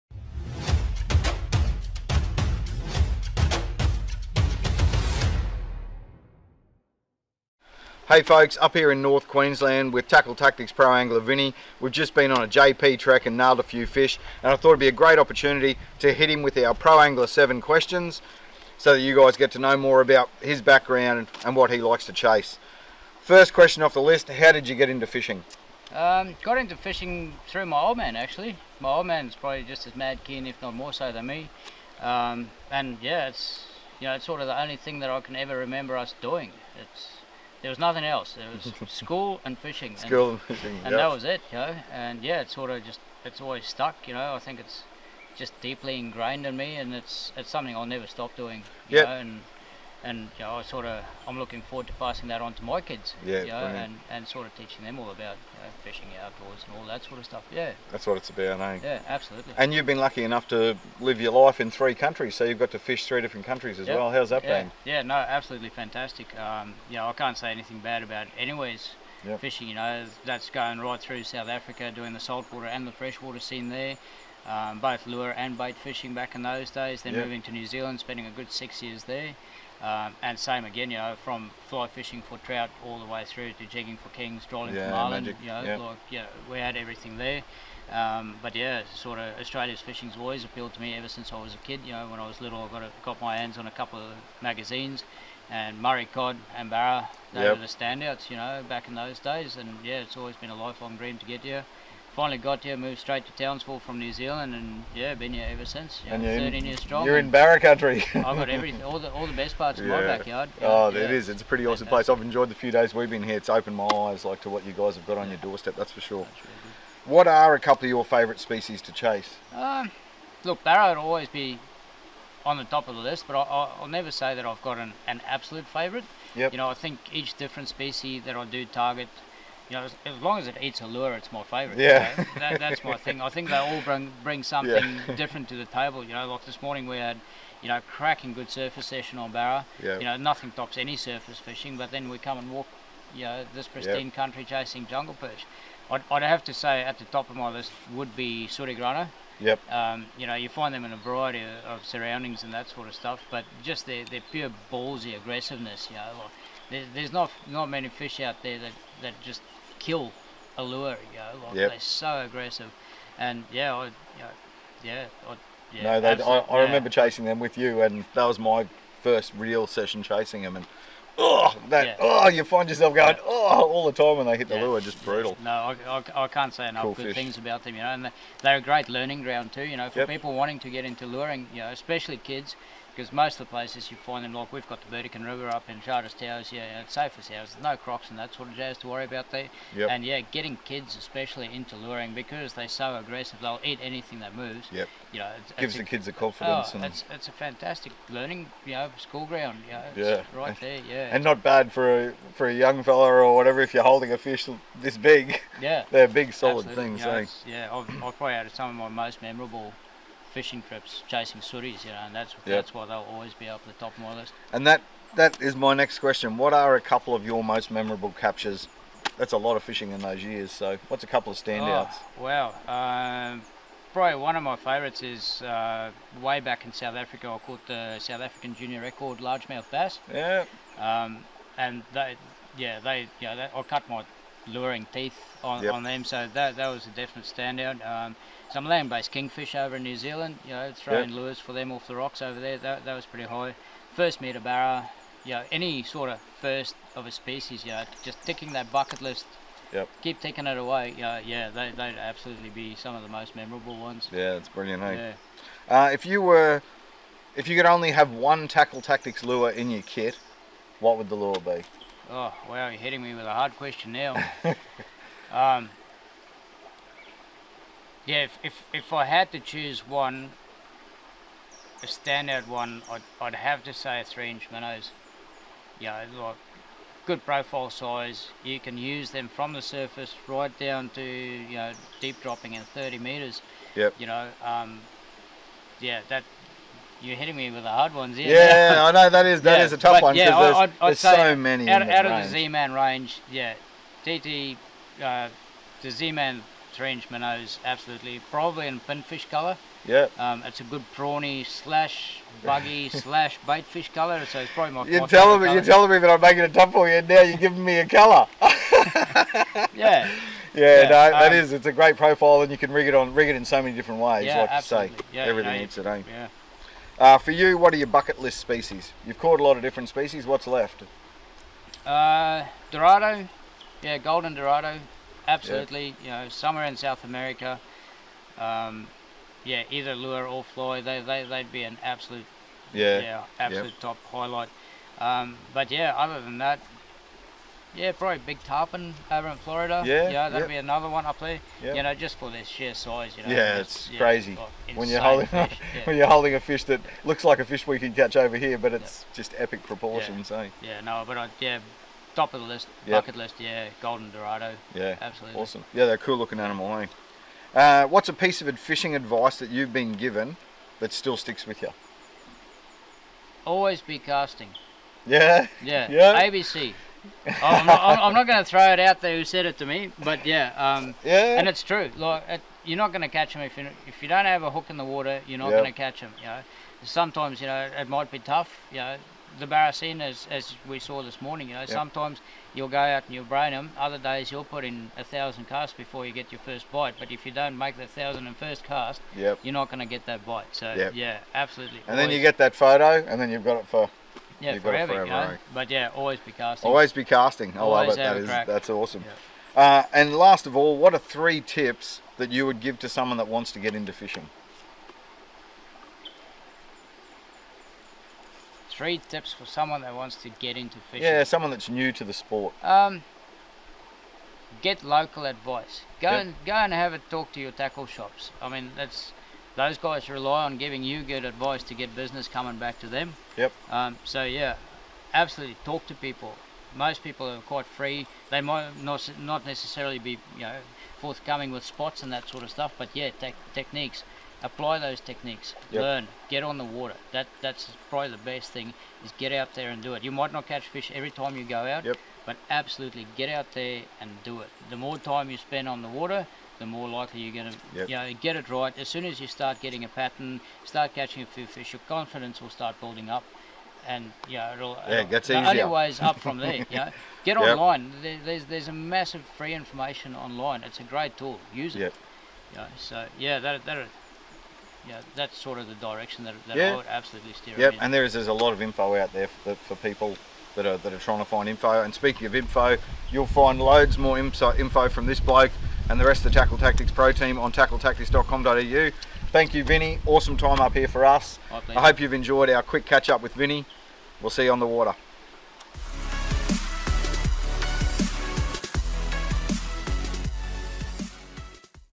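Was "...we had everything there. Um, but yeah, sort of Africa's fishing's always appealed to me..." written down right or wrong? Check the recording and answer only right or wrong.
wrong.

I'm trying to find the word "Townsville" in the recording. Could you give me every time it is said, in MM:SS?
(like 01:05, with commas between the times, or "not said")
01:43.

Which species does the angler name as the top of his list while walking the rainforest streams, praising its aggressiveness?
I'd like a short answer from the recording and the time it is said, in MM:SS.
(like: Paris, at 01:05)
Sooty grunter, at 02:28.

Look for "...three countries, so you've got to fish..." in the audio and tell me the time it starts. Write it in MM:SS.
01:01.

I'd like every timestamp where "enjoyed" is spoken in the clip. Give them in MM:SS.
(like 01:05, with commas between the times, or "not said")
01:52, 08:02.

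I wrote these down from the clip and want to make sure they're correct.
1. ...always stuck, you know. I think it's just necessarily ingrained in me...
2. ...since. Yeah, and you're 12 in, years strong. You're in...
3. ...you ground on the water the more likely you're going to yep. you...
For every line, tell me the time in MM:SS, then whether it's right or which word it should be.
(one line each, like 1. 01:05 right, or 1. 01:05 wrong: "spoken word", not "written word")
1. 00:43 wrong: "deeply", not "necessarily"
2. 01:45 wrong: "13", not "12"
3. 07:25 wrong: "spend", not "ground".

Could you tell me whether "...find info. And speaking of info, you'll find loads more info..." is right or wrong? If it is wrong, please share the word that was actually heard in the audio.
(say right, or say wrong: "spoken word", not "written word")
right.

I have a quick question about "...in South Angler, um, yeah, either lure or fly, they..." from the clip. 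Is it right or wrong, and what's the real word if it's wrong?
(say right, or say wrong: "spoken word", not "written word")
wrong: "America", not "Angler".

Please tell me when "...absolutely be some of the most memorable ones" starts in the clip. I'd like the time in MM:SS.
04:11.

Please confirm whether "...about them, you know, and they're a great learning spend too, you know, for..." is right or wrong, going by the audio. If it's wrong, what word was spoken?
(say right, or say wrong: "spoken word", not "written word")
wrong: "ground", not "spend".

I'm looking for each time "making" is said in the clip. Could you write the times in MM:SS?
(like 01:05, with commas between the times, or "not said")
05:06.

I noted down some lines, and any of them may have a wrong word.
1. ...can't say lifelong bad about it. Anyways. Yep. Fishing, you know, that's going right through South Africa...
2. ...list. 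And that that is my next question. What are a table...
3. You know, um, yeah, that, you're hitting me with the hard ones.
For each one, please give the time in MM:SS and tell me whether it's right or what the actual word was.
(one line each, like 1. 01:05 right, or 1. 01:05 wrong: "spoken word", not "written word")
1. 01:07 wrong: "anything", not "lifelong"
2. 03:34 wrong: "couple", not "table"
3. 04:43 right.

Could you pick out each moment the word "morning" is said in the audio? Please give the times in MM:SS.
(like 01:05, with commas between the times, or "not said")
02:16, 06:21.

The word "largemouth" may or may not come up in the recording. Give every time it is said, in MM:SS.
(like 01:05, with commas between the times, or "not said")
03:49.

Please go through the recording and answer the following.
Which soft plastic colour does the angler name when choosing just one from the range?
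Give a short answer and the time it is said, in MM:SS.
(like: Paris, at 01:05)
Pinfish, at 04:58.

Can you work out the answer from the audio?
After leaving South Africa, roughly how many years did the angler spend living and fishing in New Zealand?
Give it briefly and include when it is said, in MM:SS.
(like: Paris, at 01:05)
6, at 01:18.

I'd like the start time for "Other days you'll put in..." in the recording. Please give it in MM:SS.
06:23.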